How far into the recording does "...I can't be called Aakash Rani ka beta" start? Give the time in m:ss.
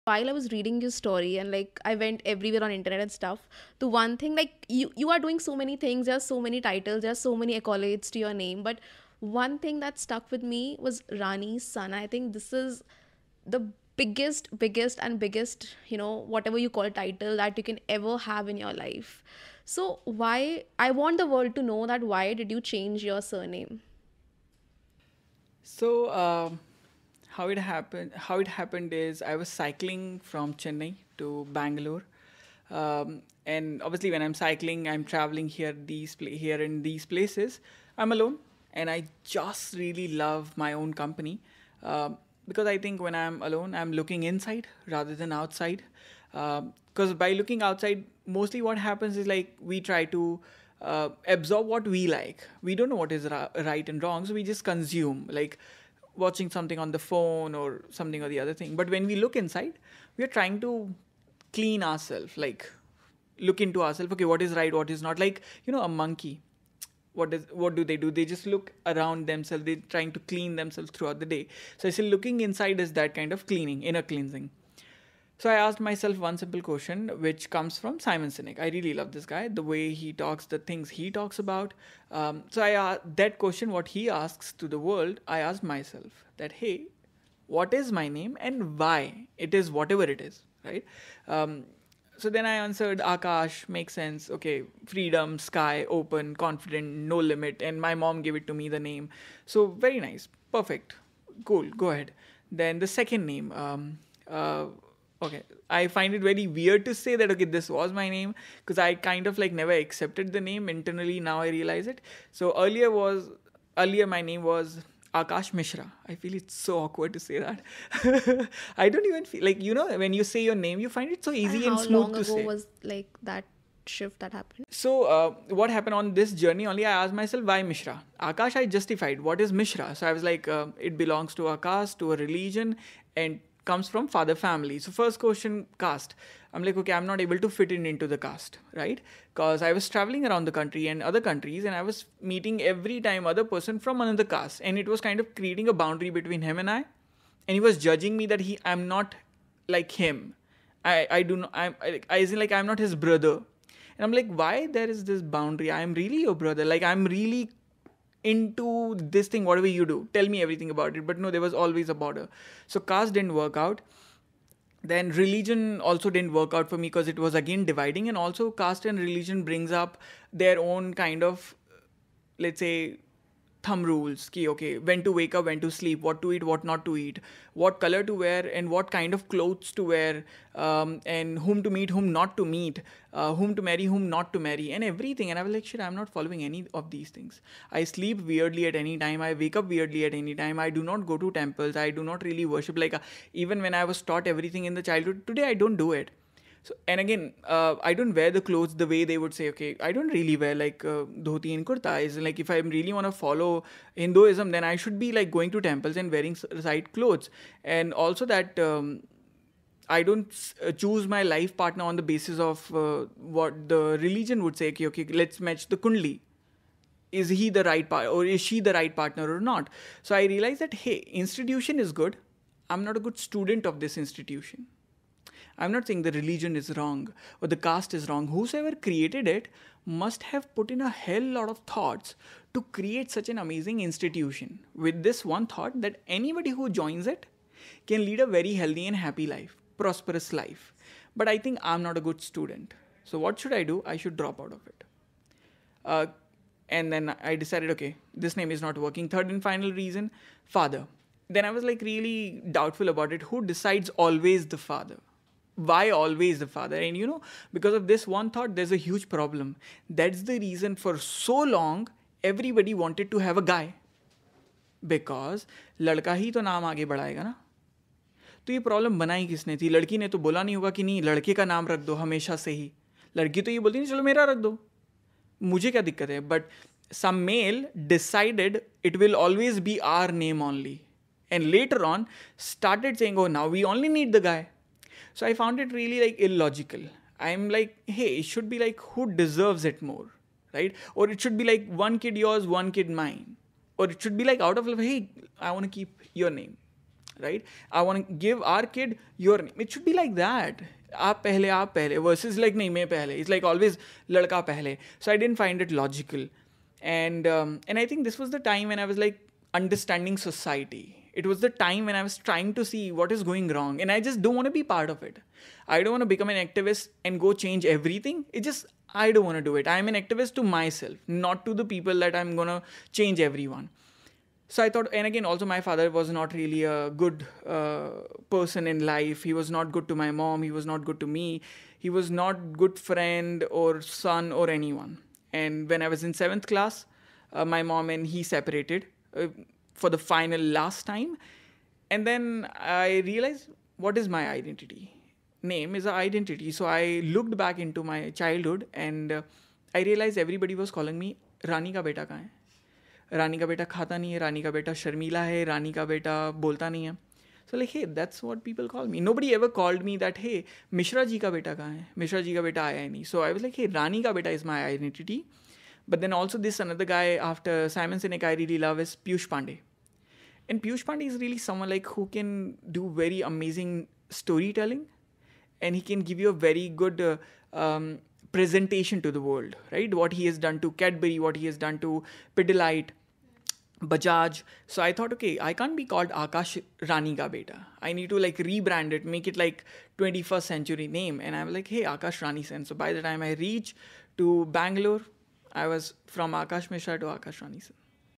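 6:25.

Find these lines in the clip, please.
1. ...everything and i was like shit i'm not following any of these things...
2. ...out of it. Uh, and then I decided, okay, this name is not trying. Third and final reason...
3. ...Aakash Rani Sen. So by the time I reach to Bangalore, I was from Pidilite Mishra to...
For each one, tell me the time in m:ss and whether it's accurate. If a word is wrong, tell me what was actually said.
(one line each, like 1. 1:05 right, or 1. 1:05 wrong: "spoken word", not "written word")
1. 3:04 right
2. 4:04 wrong: "working", not "trying"
3. 6:31 wrong: "Aakash", not "Pidilite".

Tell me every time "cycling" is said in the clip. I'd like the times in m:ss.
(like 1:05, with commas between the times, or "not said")
0:29, 0:34.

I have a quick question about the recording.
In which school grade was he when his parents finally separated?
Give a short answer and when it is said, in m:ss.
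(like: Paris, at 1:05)
Seventh class, at 5:36.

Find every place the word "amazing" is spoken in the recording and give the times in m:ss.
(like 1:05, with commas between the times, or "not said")
3:53, 6:13.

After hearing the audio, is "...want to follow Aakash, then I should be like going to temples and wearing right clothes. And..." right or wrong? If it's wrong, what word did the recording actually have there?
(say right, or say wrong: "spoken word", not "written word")
wrong: "Hinduism", not "Aakash".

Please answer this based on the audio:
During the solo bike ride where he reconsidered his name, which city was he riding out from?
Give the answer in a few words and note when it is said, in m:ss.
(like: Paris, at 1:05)
Chennai, at 0:30.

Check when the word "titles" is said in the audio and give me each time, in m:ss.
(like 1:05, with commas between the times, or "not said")
0:06, 0:16.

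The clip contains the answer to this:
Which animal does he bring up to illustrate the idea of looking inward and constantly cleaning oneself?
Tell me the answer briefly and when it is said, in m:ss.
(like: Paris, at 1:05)
A monkey, at 1:05.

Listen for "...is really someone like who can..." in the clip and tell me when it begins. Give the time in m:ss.
6:11.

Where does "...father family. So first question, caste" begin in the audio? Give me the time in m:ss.
2:14.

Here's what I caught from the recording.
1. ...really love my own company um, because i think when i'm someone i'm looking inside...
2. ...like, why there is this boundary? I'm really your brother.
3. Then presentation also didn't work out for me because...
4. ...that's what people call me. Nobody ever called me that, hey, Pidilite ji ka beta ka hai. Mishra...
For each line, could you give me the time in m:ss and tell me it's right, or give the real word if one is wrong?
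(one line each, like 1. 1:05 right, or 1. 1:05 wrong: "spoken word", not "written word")
1. 0:39 wrong: "alone", not "someone"
2. 2:34 right
3. 2:44 wrong: "religion", not "presentation"
4. 5:57 wrong: "Mishra", not "Pidilite".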